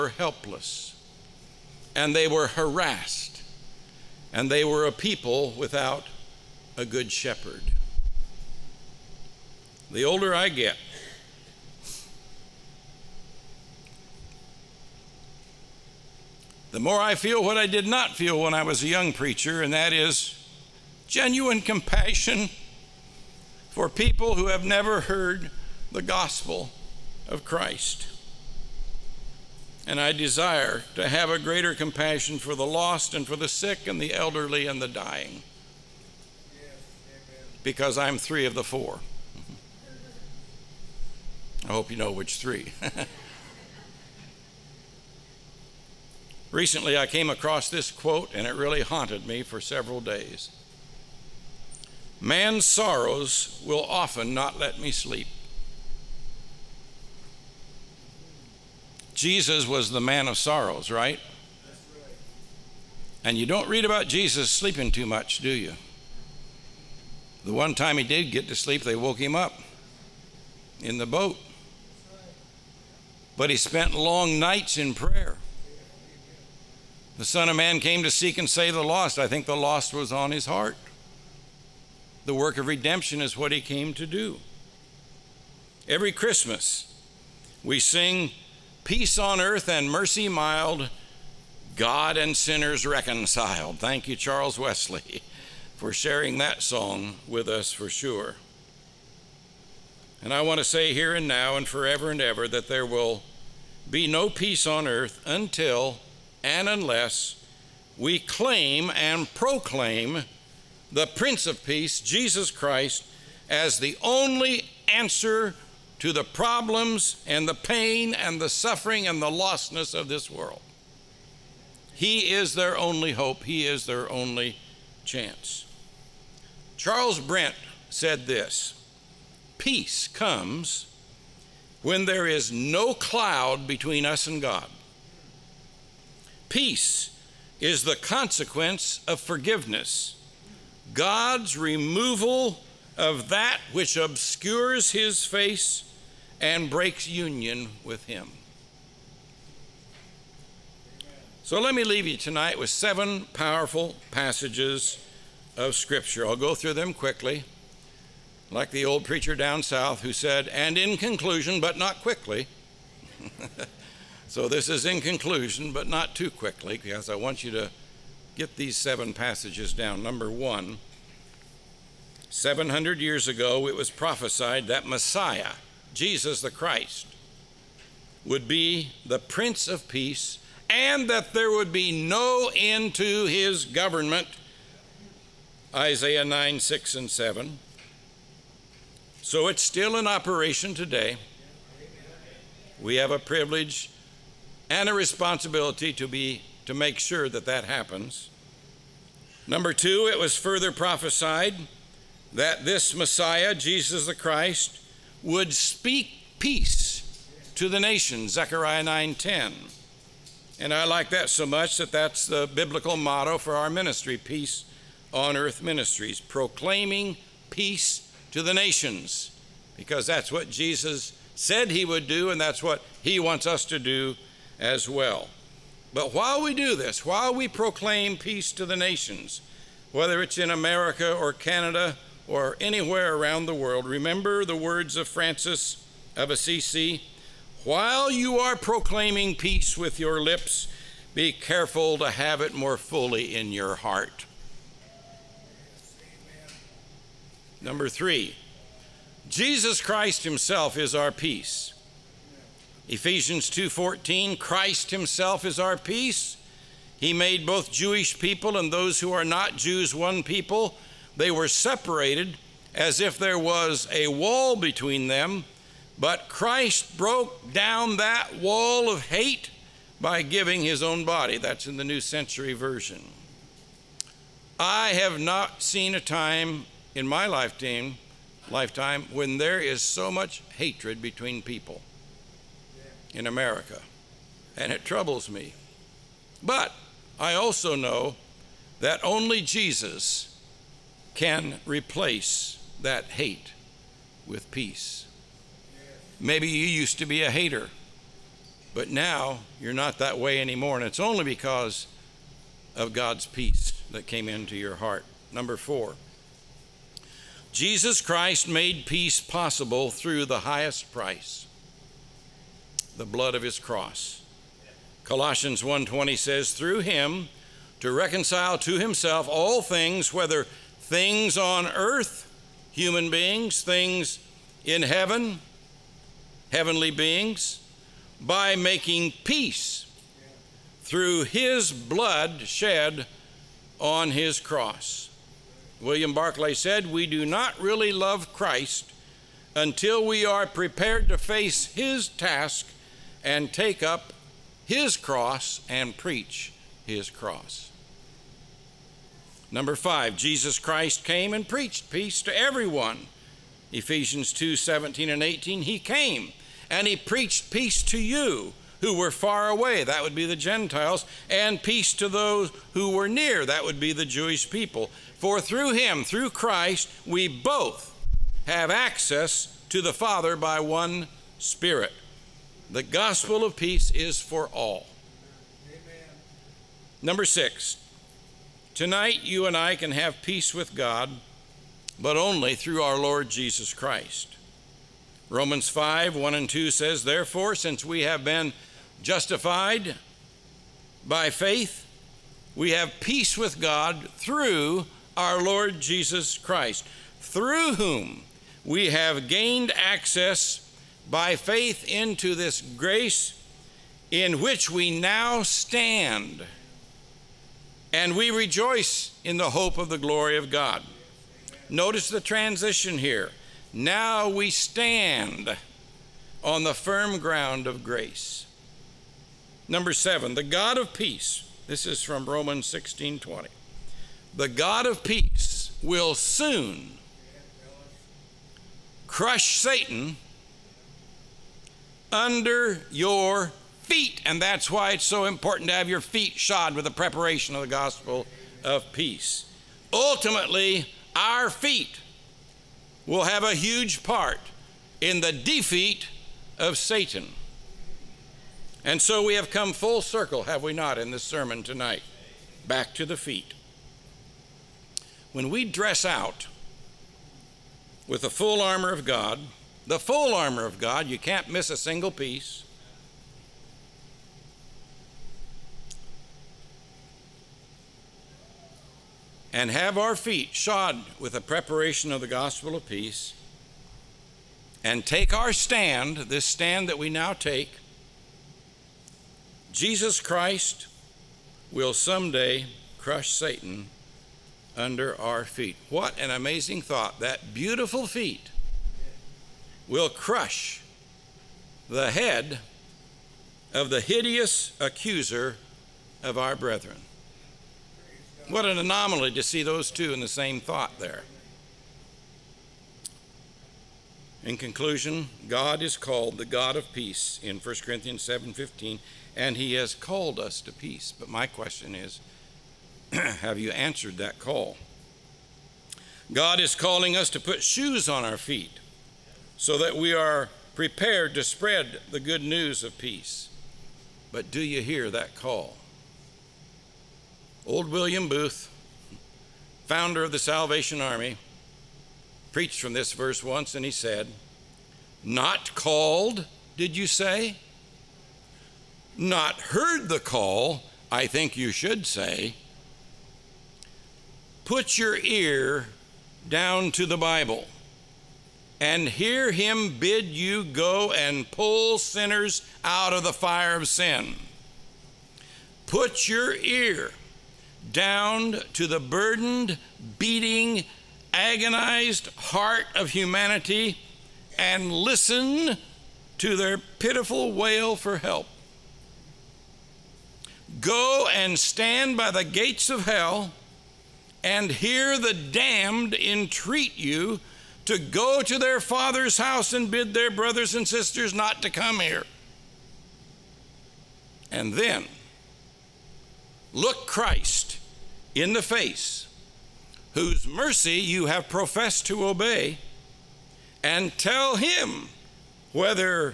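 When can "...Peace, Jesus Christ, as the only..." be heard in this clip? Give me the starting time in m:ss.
1:51.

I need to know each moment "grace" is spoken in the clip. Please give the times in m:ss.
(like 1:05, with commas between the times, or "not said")
6:42, 6:57.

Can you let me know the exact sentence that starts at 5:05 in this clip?
Number four, Jesus Christ made peace possible through the highest price, the blood of his cross.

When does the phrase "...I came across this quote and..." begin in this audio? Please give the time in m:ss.
0:46.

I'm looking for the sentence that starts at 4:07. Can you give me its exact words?
Number three, Jesus Christ himself is our peace.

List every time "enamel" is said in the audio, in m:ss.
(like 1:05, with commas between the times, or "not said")
not said.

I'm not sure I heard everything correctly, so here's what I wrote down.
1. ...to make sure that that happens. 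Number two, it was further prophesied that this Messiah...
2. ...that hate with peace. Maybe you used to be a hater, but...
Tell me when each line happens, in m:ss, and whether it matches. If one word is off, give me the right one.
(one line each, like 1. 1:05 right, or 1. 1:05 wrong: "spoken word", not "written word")
1. 3:16 right
2. 4:52 right.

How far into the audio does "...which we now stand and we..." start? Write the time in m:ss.
6:44.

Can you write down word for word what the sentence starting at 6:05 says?
For through him, through Christ, we both have access to the Father by one Spirit.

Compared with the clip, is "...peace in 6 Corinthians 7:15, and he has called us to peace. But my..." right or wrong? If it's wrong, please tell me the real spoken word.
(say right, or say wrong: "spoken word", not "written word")
wrong: "1", not "6".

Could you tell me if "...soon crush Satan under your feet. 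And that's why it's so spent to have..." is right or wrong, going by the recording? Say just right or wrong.
wrong.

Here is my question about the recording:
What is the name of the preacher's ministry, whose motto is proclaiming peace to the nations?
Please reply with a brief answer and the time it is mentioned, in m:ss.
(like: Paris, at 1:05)
Peace on Earth Ministries, at 3:34.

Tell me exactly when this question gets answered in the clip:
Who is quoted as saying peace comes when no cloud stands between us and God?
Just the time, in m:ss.
2:06.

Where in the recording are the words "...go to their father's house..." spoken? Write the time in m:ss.
9:37.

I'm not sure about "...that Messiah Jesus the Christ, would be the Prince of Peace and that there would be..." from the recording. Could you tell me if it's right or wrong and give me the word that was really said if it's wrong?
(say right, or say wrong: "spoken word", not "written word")
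right.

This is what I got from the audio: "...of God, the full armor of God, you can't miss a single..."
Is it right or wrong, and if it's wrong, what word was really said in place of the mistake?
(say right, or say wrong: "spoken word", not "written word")
right.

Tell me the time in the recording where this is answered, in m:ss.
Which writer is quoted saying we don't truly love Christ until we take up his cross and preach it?
5:35.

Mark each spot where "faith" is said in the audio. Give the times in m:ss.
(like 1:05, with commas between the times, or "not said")
6:31, 6:41.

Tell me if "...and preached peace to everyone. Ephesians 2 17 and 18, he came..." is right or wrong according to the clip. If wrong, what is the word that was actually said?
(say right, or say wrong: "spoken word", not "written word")
right.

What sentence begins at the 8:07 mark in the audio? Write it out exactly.
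That beautiful feet will crush the head of the hideous accuser of our brethren.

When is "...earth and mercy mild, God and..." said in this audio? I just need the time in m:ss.
1:29.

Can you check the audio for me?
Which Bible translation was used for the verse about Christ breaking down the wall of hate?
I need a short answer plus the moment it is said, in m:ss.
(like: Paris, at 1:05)
New Century Version, at 4:31.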